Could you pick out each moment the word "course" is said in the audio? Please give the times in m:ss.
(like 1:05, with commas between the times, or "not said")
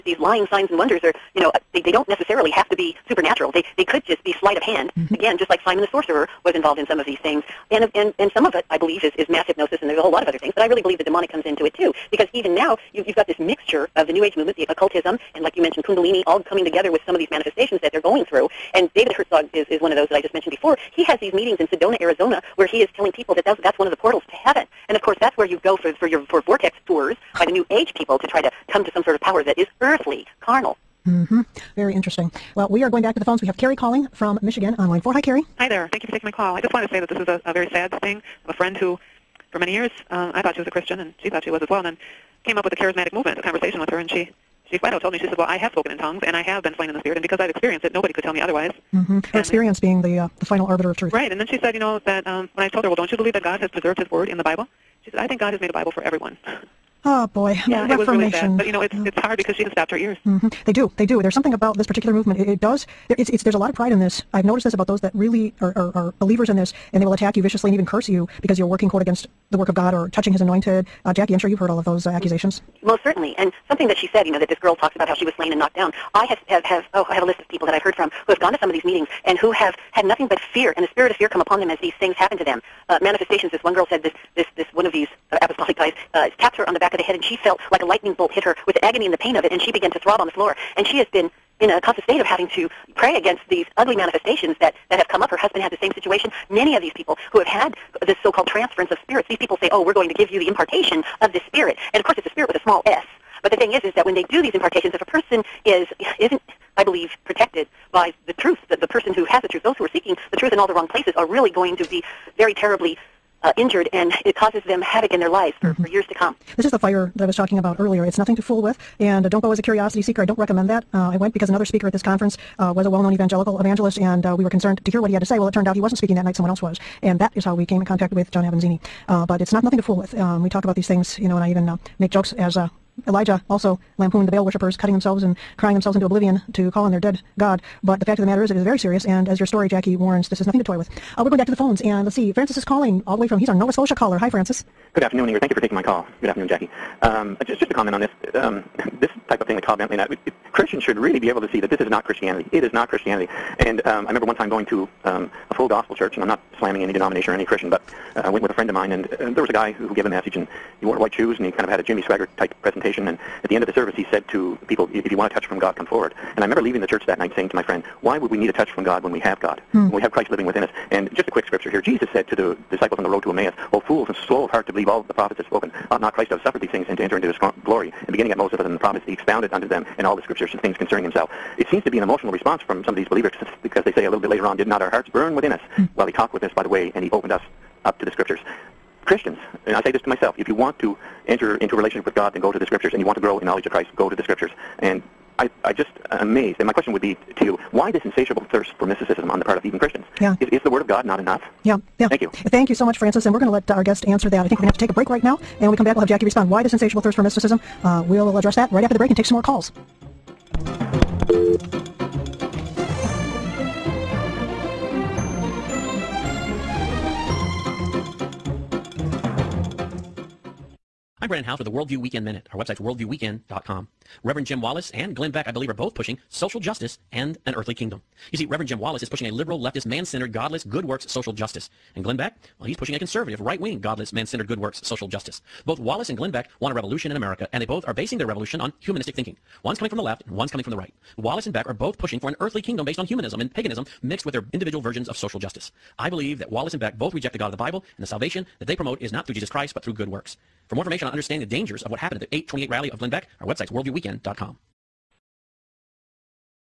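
0:25, 1:42.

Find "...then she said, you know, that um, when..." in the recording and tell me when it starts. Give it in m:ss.
0:51.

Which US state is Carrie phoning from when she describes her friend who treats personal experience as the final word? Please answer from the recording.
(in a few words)
Michigan.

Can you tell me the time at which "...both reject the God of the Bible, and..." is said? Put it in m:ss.
4:06.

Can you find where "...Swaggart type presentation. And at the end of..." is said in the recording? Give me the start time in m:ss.
2:42.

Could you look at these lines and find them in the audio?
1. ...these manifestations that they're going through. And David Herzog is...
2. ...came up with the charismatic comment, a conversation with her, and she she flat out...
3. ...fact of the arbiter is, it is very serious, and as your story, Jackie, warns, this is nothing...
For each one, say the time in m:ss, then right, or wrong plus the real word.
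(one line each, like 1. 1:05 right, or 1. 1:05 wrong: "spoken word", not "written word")
1. 0:17 right
2. 0:42 wrong: "movement", not "comment"
3. 2:18 wrong: "matter", not "arbiter".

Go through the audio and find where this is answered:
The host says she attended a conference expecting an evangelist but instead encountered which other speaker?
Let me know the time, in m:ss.
2:08.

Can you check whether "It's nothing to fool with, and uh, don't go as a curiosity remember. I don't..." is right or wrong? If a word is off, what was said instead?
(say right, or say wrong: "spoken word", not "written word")
wrong: "seeker", not "remember".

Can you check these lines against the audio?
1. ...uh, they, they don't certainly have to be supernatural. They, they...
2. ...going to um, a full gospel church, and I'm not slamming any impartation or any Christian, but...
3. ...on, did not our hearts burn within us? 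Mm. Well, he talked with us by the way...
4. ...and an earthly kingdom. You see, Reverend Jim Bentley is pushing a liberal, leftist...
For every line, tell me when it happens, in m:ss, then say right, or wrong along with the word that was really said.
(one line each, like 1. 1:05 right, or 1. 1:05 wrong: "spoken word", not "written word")
1. 0:01 wrong: "necessarily", not "certainly"
2. 2:34 wrong: "denomination", not "impartation"
3. 3:04 right
4. 3:47 wrong: "Wallis", not "Bentley".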